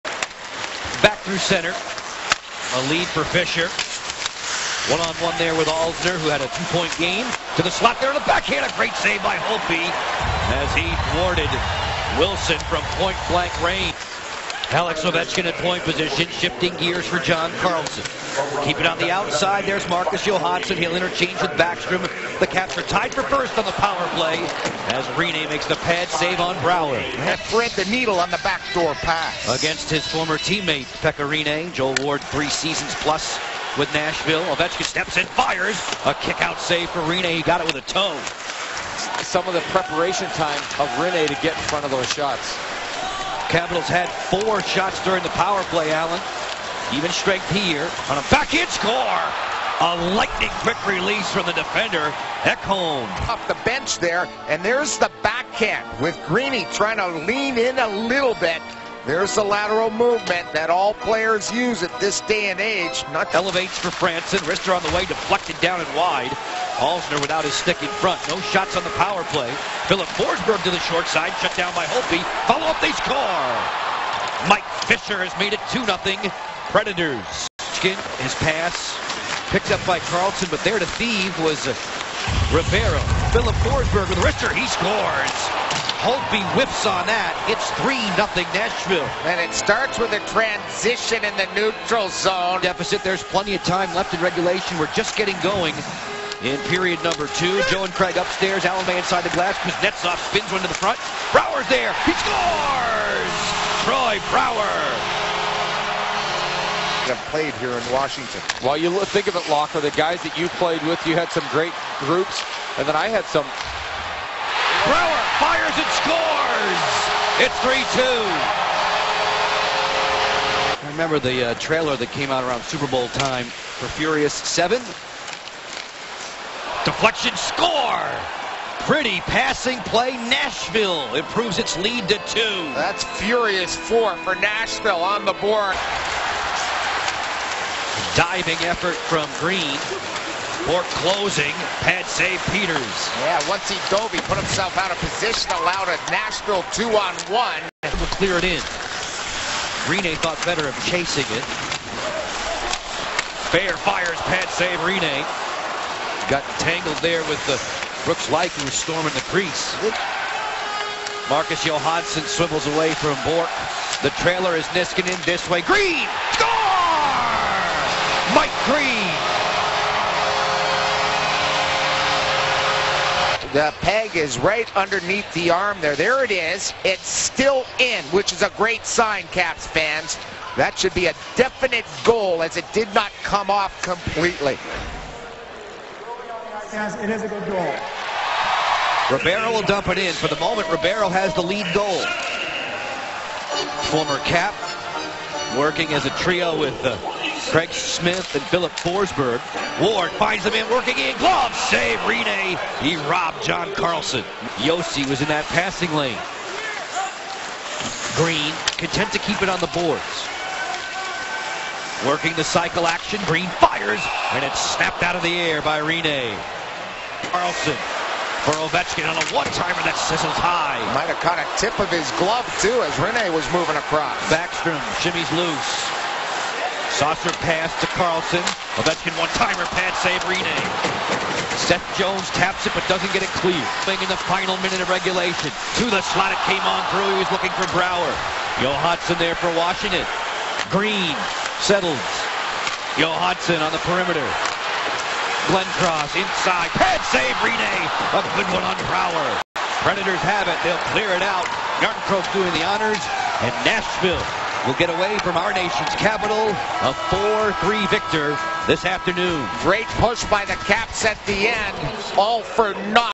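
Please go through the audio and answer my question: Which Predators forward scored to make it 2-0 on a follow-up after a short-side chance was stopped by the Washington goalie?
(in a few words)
Mike Fisher.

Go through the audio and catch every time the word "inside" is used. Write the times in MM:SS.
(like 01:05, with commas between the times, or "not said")
01:38, 04:06.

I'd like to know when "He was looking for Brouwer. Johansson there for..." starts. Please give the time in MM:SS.
03:57.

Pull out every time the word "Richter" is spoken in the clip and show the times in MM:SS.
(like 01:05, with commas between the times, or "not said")
01:24.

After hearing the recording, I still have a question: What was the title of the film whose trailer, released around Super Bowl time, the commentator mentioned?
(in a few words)
Furious 7.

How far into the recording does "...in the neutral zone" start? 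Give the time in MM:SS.
01:31.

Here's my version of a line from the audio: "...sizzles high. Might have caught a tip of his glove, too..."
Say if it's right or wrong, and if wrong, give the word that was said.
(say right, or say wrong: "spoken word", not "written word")
right.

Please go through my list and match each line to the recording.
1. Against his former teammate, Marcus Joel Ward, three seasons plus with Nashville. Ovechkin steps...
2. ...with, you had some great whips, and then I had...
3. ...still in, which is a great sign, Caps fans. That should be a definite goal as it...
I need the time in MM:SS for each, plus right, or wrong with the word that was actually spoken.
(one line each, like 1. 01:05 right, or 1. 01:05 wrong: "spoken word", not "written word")
1. 00:29 wrong: "Pekka", not "Marcus"
2. 01:50 wrong: "groups", not "whips"
3. 02:57 right.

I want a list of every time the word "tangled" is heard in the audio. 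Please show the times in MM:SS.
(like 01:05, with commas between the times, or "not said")
02:36.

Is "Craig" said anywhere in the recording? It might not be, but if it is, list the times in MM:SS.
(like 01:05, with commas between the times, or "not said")
01:37, 03:17.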